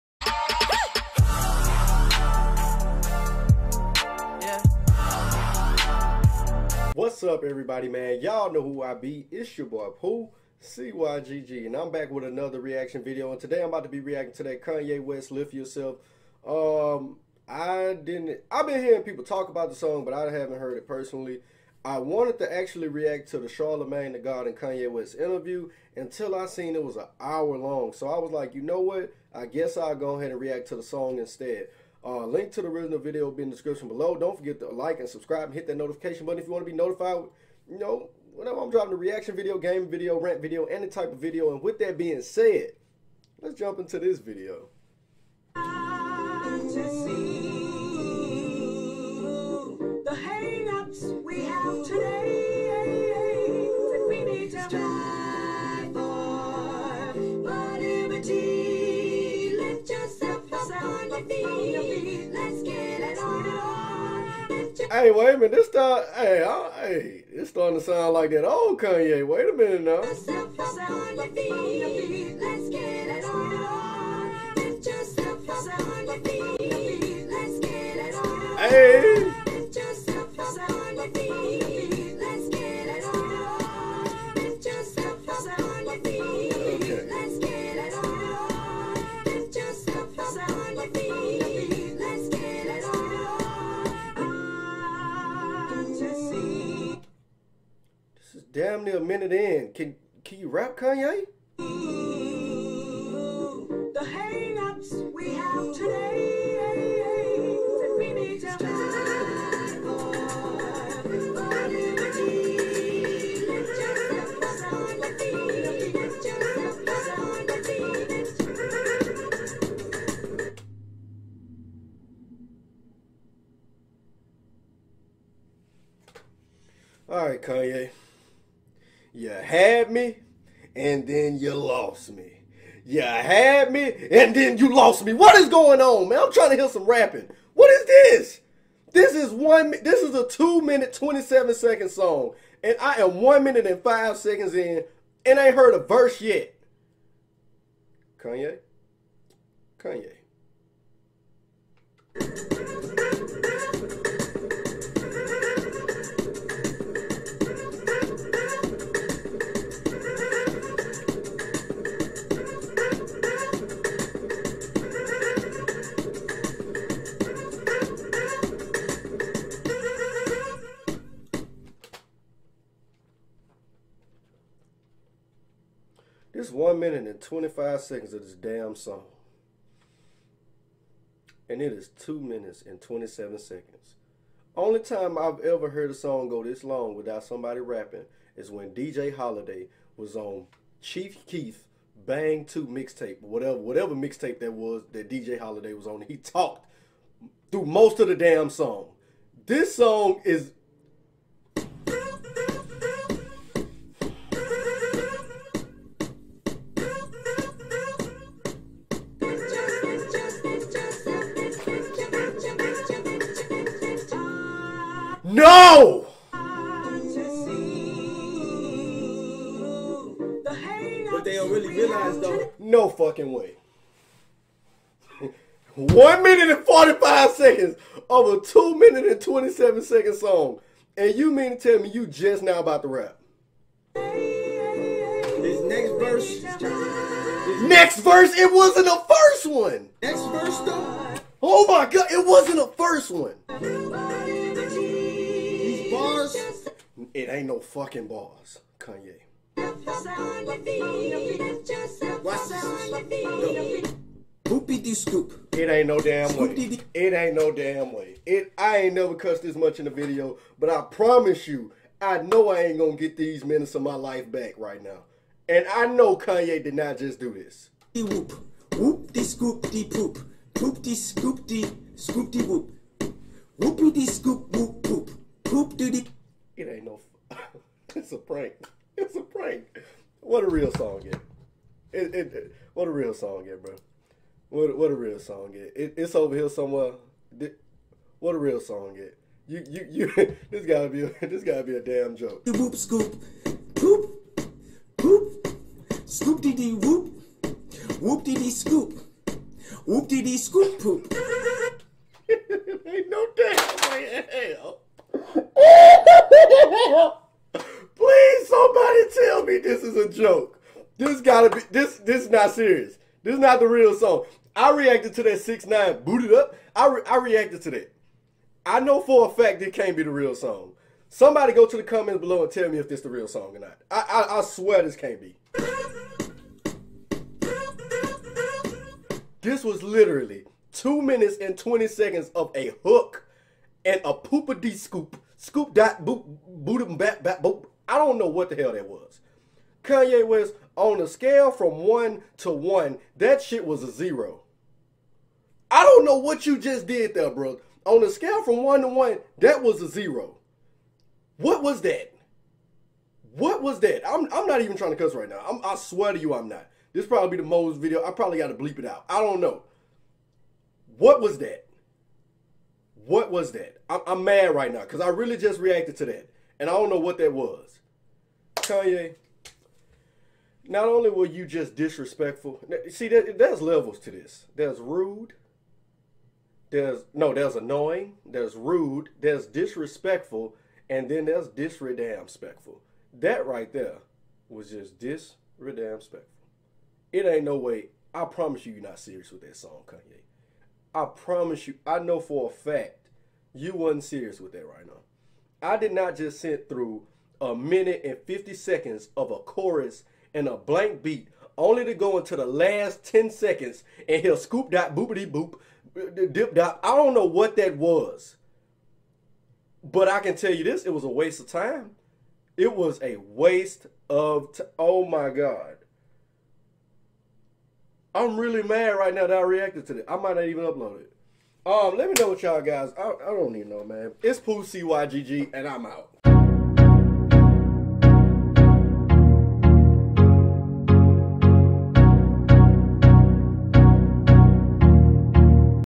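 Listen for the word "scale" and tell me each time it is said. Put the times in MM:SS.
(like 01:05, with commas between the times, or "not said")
05:41, 05:48.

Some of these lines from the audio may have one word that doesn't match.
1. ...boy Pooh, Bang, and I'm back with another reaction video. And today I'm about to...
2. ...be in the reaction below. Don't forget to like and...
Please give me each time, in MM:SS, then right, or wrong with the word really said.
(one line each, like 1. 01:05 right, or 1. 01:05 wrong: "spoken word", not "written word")
1. 00:09 wrong: "CYGG", not "Bang"
2. 00:33 wrong: "description", not "reaction".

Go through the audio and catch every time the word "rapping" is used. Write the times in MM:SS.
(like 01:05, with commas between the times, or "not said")
02:16, 03:07.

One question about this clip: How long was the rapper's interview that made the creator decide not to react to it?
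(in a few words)
An hour.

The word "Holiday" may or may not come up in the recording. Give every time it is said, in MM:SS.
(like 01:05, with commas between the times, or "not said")
03:09, 03:15.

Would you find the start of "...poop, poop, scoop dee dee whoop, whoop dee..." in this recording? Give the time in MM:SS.
04:53.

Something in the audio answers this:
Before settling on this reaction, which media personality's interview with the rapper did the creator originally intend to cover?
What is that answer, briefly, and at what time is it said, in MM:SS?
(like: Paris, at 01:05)
Charlamagne the God, at 00:23.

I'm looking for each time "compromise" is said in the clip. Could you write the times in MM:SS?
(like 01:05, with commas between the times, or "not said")
not said.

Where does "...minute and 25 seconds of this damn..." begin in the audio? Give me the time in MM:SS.
02:56.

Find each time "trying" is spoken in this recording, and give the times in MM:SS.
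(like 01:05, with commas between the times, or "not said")
02:16, 05:54.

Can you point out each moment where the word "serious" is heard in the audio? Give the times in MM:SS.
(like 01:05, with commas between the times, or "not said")
05:12, 06:28, 06:34.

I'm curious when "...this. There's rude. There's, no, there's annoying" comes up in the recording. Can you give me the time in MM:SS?
06:14.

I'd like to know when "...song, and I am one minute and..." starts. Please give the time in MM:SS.
02:21.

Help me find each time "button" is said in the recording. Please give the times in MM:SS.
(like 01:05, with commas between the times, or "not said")
00:36.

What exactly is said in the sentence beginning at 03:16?
He talked through most of the damn song.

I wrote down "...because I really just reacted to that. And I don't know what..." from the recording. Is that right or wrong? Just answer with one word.
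right.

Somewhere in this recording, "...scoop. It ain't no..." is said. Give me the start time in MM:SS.
04:14.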